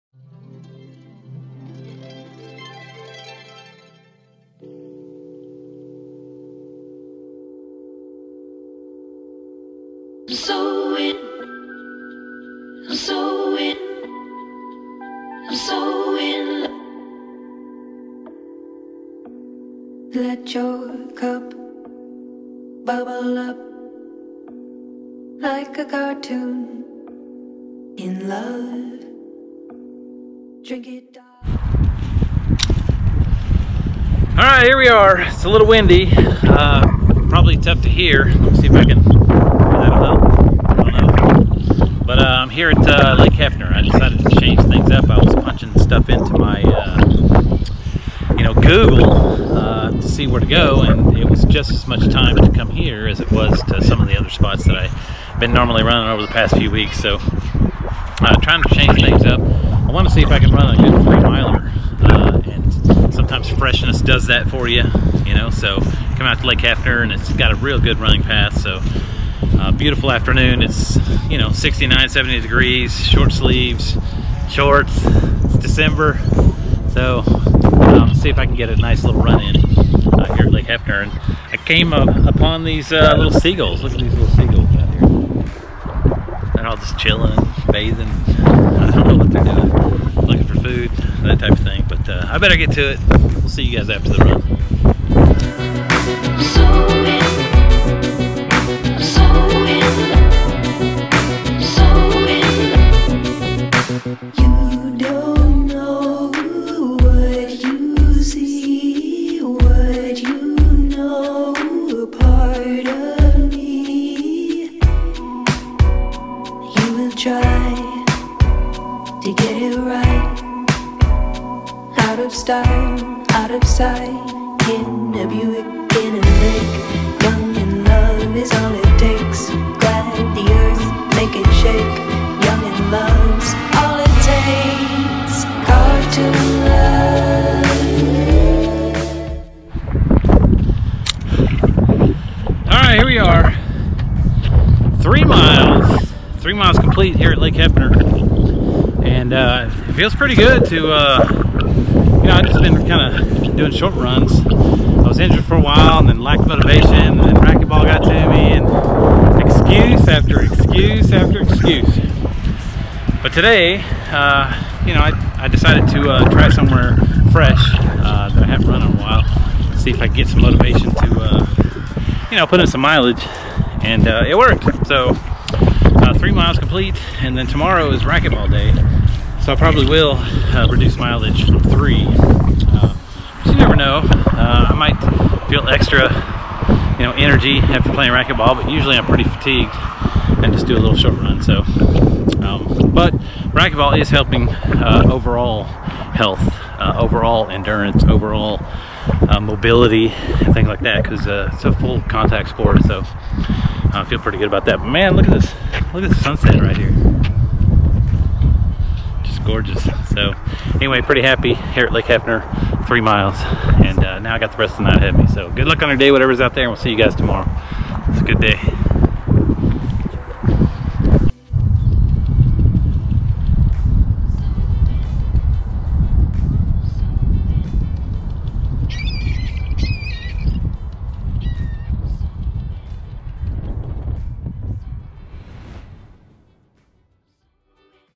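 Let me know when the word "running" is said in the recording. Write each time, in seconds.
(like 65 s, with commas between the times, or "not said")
55 s, 67 s.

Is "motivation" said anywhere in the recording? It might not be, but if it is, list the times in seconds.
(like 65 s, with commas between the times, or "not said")
156 s, 170 s.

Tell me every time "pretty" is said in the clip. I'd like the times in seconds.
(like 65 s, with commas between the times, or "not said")
150 s, 189 s, 204 s, 211 s.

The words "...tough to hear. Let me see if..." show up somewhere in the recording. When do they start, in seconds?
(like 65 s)
37 s.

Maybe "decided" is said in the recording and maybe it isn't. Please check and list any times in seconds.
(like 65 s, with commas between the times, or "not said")
43 s, 165 s.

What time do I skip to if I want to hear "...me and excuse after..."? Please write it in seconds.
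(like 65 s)
158 s.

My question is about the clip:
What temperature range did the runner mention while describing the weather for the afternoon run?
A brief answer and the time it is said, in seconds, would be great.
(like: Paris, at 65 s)
69-70 degrees, at 71 s.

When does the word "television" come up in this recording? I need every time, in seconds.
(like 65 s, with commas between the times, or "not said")
not said.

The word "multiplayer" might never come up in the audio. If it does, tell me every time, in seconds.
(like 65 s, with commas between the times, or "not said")
not said.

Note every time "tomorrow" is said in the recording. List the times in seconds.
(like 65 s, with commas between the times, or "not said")
177 s, 217 s.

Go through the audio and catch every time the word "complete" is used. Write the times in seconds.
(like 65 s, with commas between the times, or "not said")
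146 s, 176 s.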